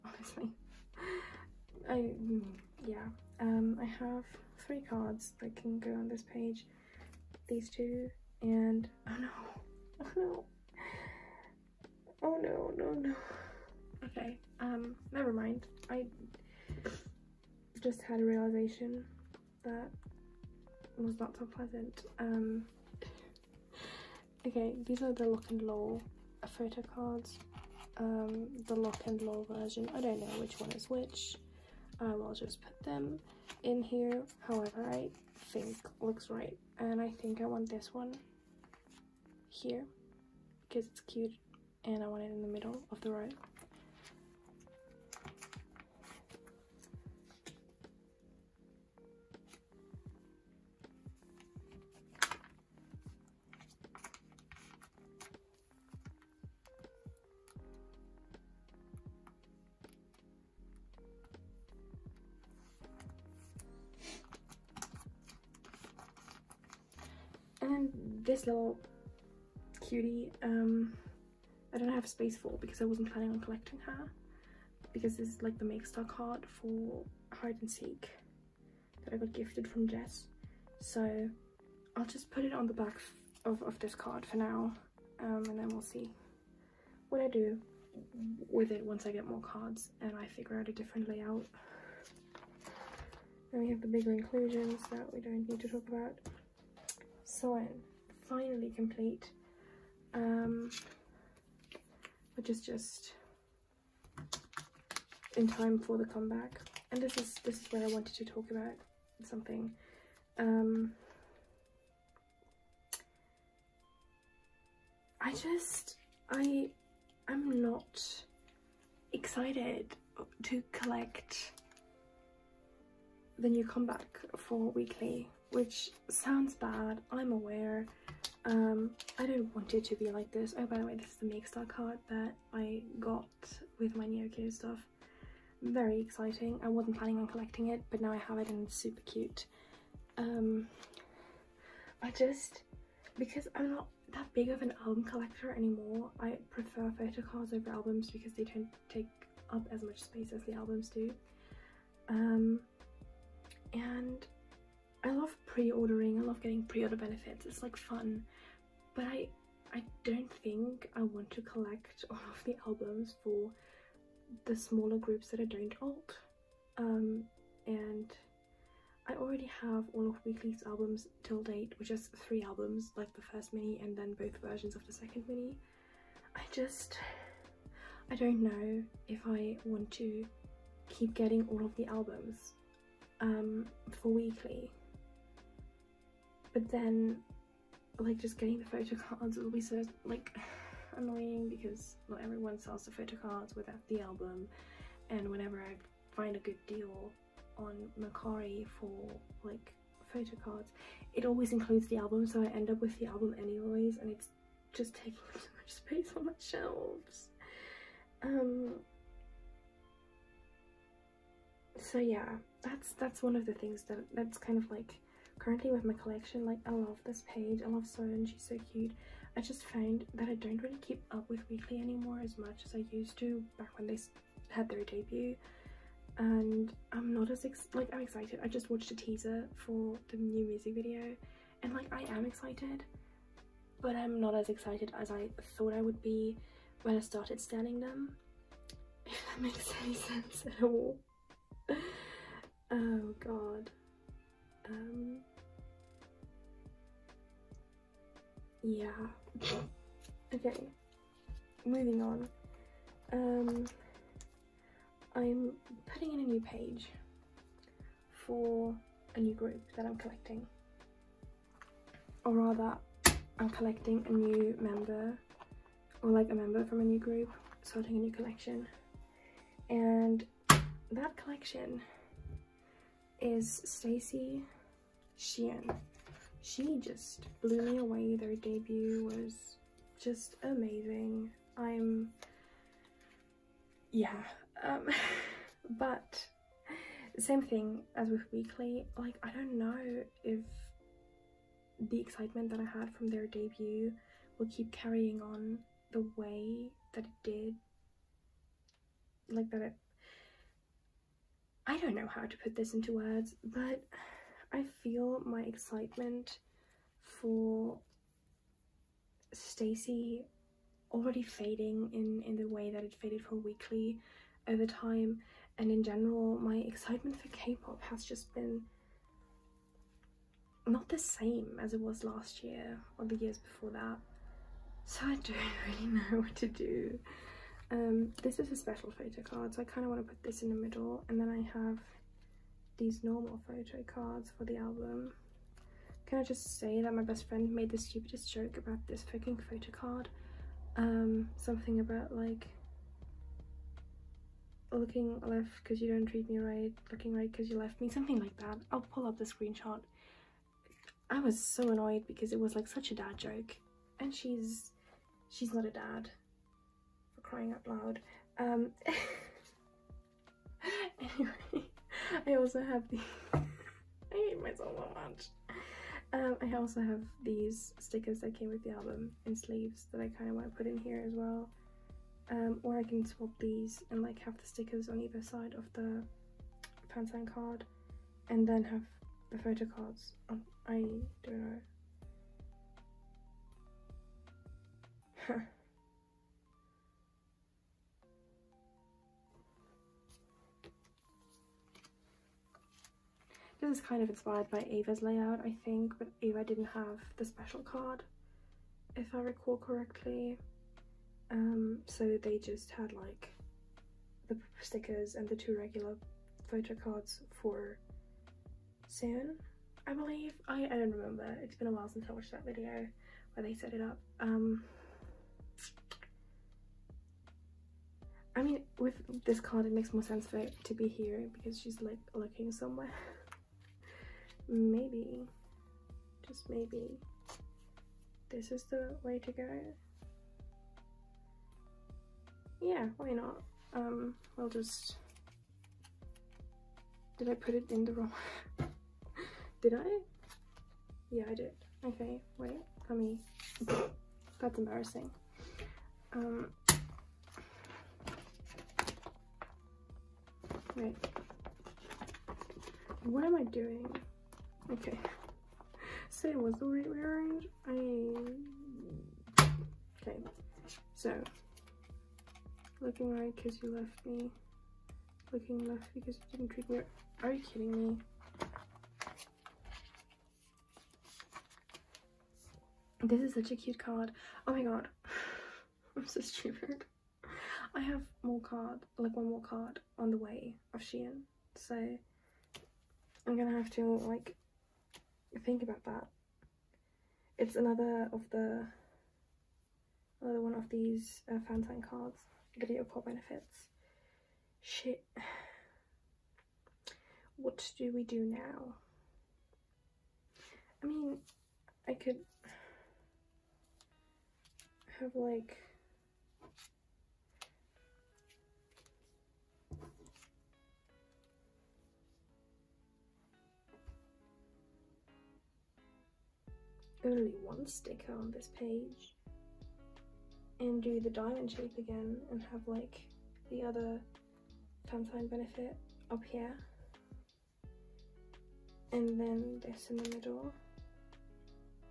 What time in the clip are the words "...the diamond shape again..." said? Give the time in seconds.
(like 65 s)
521 s.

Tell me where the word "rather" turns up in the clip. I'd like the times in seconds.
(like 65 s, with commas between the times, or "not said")
262 s.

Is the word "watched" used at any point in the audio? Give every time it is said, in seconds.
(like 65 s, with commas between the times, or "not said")
228 s, 412 s.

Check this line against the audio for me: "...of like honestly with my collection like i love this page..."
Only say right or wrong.
wrong.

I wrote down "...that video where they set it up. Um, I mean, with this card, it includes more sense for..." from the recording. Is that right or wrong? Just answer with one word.
wrong.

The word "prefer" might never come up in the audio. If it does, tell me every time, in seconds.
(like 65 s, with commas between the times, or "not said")
146 s.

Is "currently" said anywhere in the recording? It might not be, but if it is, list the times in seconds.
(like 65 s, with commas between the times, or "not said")
215 s.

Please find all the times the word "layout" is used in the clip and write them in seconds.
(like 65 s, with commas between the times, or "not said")
91 s, 395 s.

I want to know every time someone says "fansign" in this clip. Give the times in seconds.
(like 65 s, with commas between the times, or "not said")
376 s, 491 s.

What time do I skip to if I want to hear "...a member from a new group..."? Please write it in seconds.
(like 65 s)
266 s.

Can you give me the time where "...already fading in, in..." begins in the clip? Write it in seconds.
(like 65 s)
310 s.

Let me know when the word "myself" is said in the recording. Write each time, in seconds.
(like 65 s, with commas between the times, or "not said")
364 s.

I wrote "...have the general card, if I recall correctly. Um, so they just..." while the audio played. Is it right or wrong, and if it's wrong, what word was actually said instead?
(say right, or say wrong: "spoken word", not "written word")
wrong: "special", not "general".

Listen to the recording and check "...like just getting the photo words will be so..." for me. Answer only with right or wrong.
wrong.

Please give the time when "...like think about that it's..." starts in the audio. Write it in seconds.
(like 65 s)
483 s.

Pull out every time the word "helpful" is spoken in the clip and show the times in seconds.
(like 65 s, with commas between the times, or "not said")
not said.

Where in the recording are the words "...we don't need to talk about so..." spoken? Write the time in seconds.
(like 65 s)
95 s.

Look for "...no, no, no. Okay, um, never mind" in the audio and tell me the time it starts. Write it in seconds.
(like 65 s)
12 s.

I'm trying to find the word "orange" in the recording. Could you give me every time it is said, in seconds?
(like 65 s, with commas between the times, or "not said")
not said.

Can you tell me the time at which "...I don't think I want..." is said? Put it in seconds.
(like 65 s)
159 s.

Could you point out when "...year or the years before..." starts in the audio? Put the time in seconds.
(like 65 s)
322 s.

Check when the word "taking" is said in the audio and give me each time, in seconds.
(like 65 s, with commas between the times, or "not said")
204 s.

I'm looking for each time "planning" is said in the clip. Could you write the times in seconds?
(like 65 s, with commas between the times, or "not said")
73 s, 136 s.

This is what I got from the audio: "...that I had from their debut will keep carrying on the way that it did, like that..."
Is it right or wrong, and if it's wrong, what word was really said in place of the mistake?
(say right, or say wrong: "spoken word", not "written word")
right.